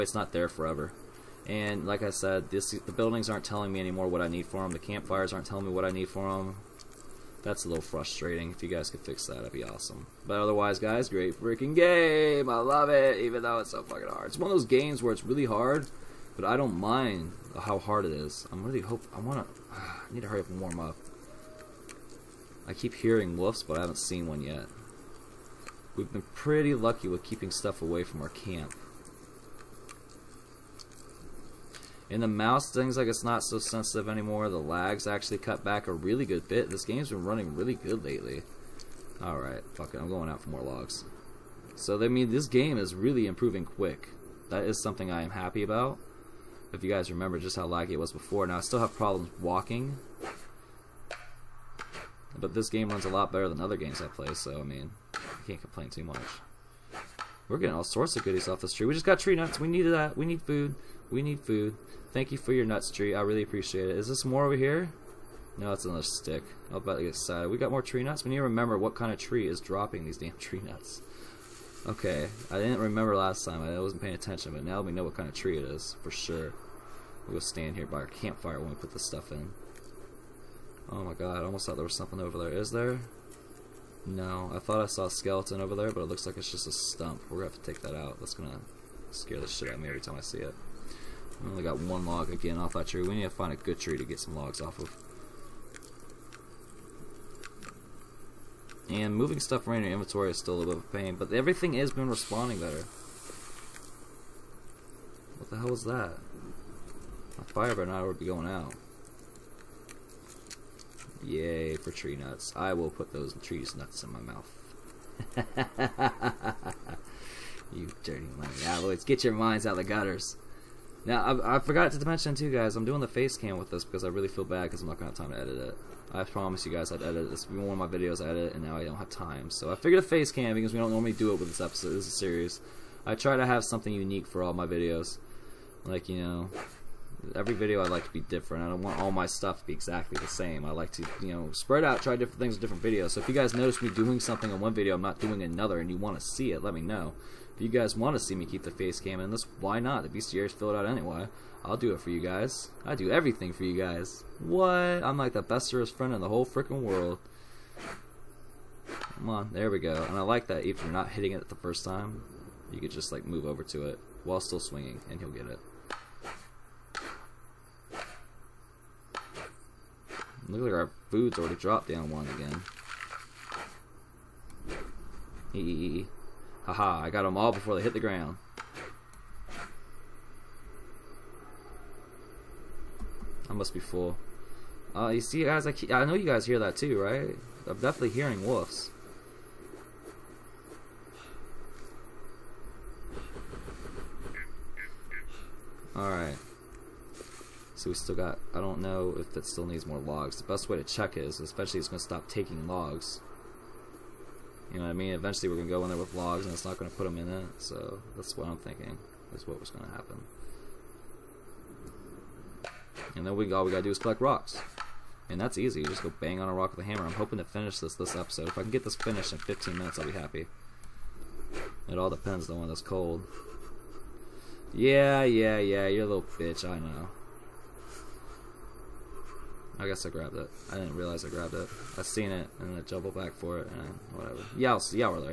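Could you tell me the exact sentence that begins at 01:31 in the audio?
I only got one log again off that tree.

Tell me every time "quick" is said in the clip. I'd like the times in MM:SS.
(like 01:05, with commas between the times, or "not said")
00:43.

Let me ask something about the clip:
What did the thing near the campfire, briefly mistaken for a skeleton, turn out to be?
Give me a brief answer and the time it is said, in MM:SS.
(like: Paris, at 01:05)
a stump, at 01:26.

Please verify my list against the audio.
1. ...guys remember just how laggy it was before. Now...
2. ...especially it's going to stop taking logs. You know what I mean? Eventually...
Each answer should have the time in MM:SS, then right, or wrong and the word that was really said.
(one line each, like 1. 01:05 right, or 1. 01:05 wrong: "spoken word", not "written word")
1. 00:46 right
2. 03:21 right.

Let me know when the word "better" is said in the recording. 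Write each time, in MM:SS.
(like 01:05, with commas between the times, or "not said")
00:53, 01:42.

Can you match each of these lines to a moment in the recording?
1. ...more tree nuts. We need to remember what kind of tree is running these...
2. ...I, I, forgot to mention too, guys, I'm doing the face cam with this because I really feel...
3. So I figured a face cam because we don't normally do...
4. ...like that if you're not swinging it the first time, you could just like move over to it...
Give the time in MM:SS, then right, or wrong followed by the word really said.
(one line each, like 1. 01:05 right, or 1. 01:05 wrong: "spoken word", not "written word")
1. 01:07 wrong: "dropping", not "running"
2. 02:01 right
3. 02:09 right
4. 02:40 wrong: "hitting", not "swinging".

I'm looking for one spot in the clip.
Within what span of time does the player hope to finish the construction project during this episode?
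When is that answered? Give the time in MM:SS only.
03:39.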